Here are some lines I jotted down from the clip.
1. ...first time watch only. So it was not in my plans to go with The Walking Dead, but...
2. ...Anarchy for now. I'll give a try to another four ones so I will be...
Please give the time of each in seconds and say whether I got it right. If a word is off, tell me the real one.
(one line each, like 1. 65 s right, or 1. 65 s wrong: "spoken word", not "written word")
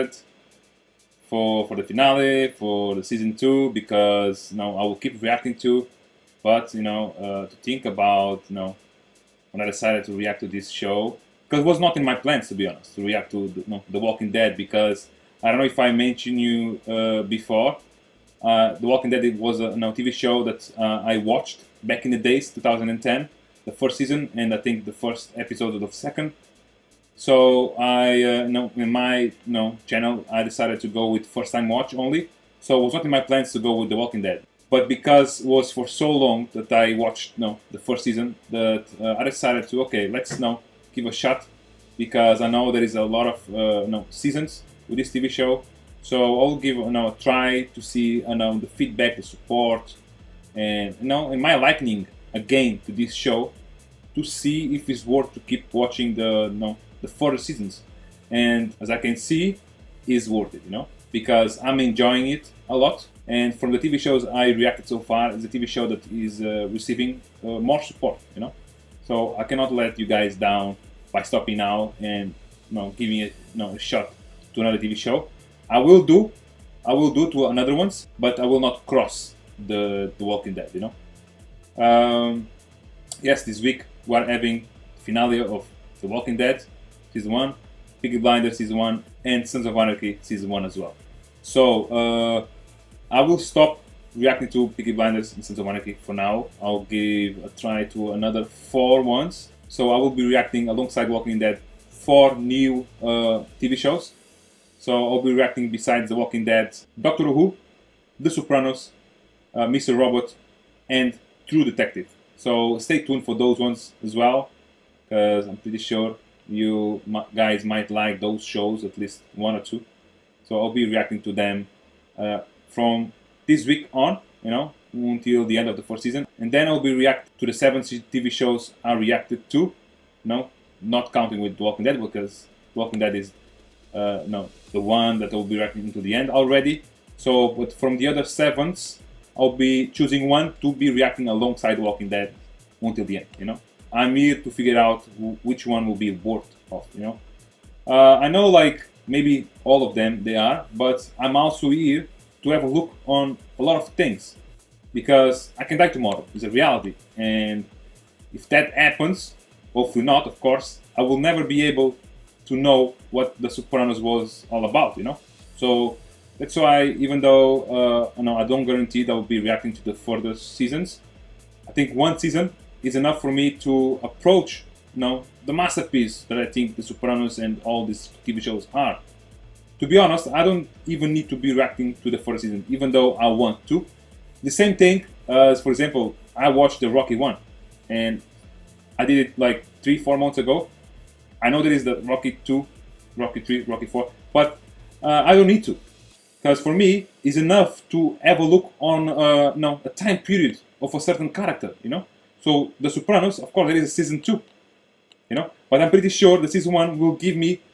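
1. 31 s right
2. 95 s right.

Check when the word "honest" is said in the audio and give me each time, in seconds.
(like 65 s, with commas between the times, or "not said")
12 s, 179 s.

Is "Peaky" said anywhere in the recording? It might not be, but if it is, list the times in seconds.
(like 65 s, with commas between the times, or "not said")
88 s, 94 s.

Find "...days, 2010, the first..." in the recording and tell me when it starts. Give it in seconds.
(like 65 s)
22 s.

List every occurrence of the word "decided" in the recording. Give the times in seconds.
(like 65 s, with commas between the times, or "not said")
9 s, 30 s, 39 s.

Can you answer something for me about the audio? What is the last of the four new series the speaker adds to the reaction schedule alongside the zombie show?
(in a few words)
True Detective.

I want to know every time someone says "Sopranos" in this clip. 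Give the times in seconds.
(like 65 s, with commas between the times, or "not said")
108 s, 163 s, 176 s, 202 s.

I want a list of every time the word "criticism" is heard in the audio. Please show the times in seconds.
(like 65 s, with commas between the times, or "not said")
not said.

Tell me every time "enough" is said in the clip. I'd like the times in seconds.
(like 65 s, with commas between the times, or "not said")
172 s, 197 s.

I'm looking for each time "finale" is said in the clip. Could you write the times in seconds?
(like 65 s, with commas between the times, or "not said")
1 s, 84 s.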